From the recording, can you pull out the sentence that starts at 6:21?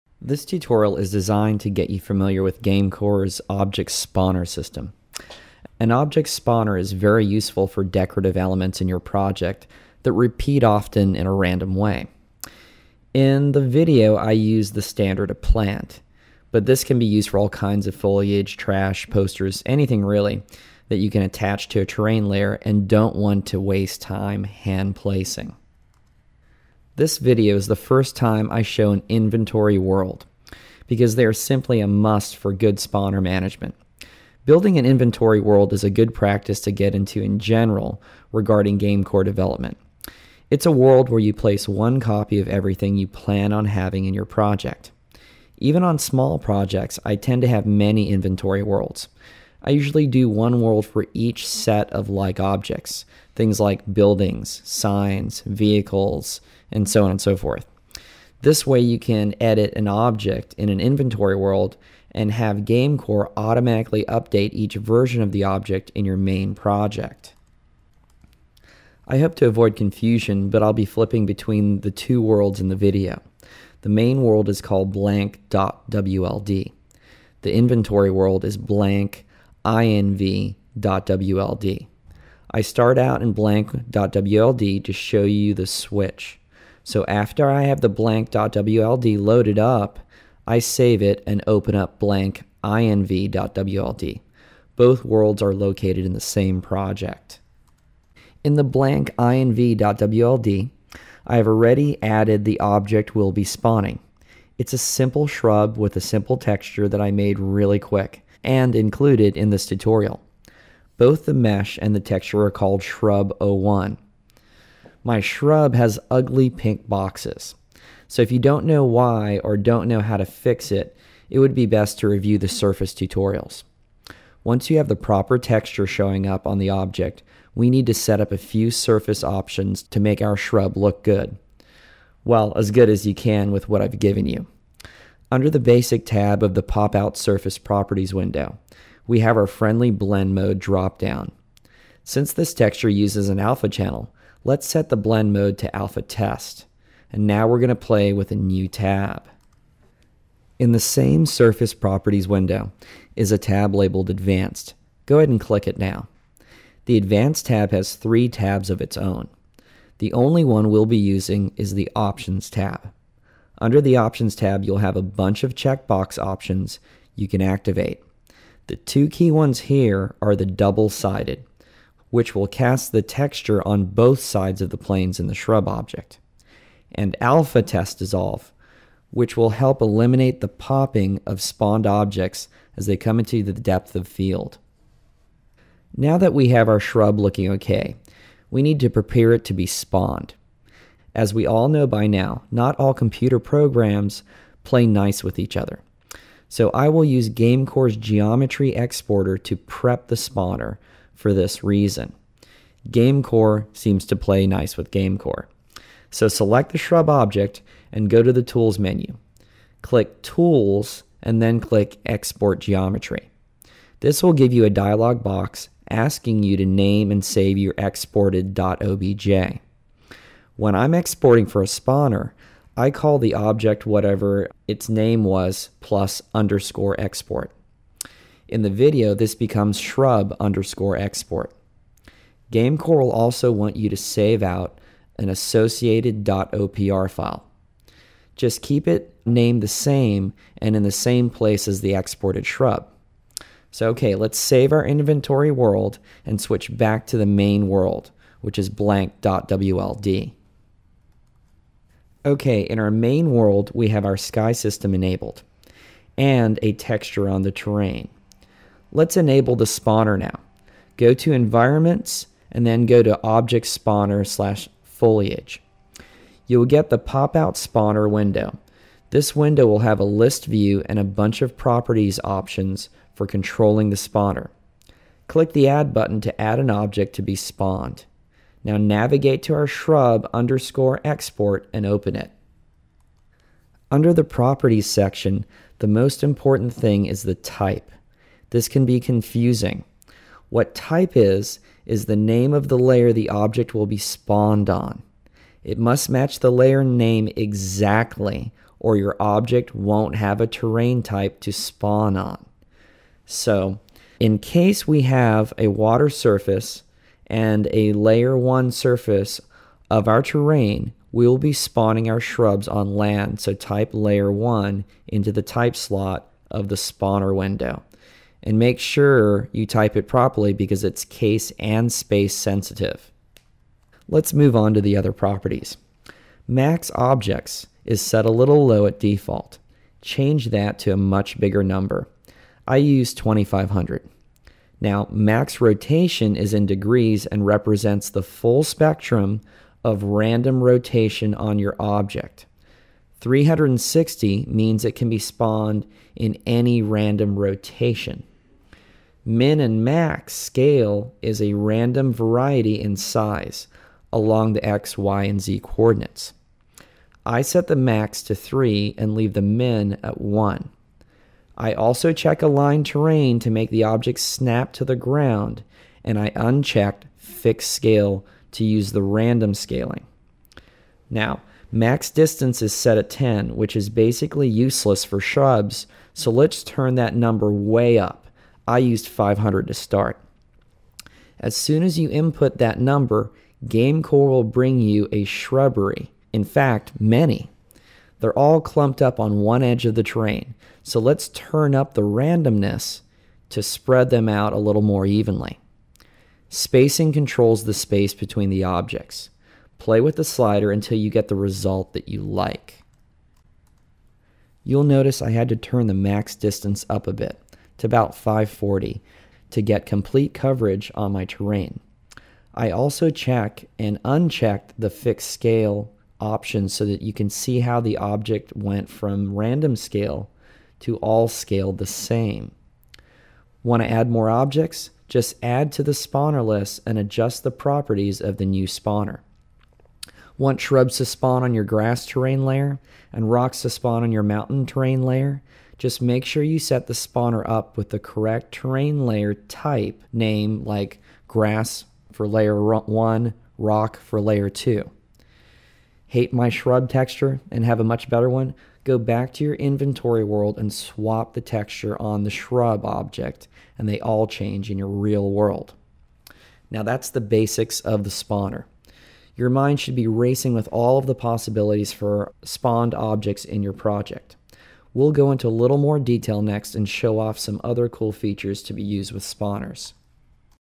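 As soon as you input that number, GameCore will bring you a shrubbery.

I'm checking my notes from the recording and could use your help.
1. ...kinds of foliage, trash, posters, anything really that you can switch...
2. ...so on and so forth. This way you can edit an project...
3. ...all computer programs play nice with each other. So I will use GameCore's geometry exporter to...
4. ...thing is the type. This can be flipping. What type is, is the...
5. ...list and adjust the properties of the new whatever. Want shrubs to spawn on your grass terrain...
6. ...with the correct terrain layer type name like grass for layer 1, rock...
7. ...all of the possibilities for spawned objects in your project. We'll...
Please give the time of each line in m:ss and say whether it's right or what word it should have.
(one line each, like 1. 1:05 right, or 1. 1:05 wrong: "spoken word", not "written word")
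1. 0:17 wrong: "attach", not "switch"
2. 0:56 wrong: "object", not "project"
3. 3:12 right
4. 4:46 wrong: "confusing", not "flipping"
5. 7:06 wrong: "spawner", not "whatever"
6. 7:17 right
7. 7:40 right.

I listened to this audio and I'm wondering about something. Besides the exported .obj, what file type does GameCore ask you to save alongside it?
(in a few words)
.opr.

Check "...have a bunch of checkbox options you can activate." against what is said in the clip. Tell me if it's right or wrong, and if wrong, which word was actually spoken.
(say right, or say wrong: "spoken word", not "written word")
right.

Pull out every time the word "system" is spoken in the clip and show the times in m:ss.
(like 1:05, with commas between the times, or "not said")
0:04, 4:14.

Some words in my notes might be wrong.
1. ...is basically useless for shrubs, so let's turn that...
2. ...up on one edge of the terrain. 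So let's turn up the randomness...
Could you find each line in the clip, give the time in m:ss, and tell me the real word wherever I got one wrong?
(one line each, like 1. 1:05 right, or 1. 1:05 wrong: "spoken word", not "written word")
1. 6:13 right
2. 6:29 right.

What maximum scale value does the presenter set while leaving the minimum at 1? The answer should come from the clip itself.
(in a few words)
3.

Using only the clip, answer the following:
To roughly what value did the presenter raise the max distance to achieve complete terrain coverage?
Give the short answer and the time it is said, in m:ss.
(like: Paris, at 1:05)
540, at 6:48.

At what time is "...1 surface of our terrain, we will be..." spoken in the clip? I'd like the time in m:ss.
5:08.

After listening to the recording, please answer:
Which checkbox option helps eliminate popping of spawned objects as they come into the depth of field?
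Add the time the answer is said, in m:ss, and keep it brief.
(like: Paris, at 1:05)
alpha test dissolve, at 2:57.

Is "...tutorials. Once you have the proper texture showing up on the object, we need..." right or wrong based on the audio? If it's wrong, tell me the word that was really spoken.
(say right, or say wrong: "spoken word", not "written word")
right.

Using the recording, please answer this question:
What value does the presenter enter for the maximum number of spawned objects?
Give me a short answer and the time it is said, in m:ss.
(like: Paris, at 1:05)
2500, at 5:33.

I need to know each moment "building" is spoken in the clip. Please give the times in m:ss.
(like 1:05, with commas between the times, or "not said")
0:34, 0:53.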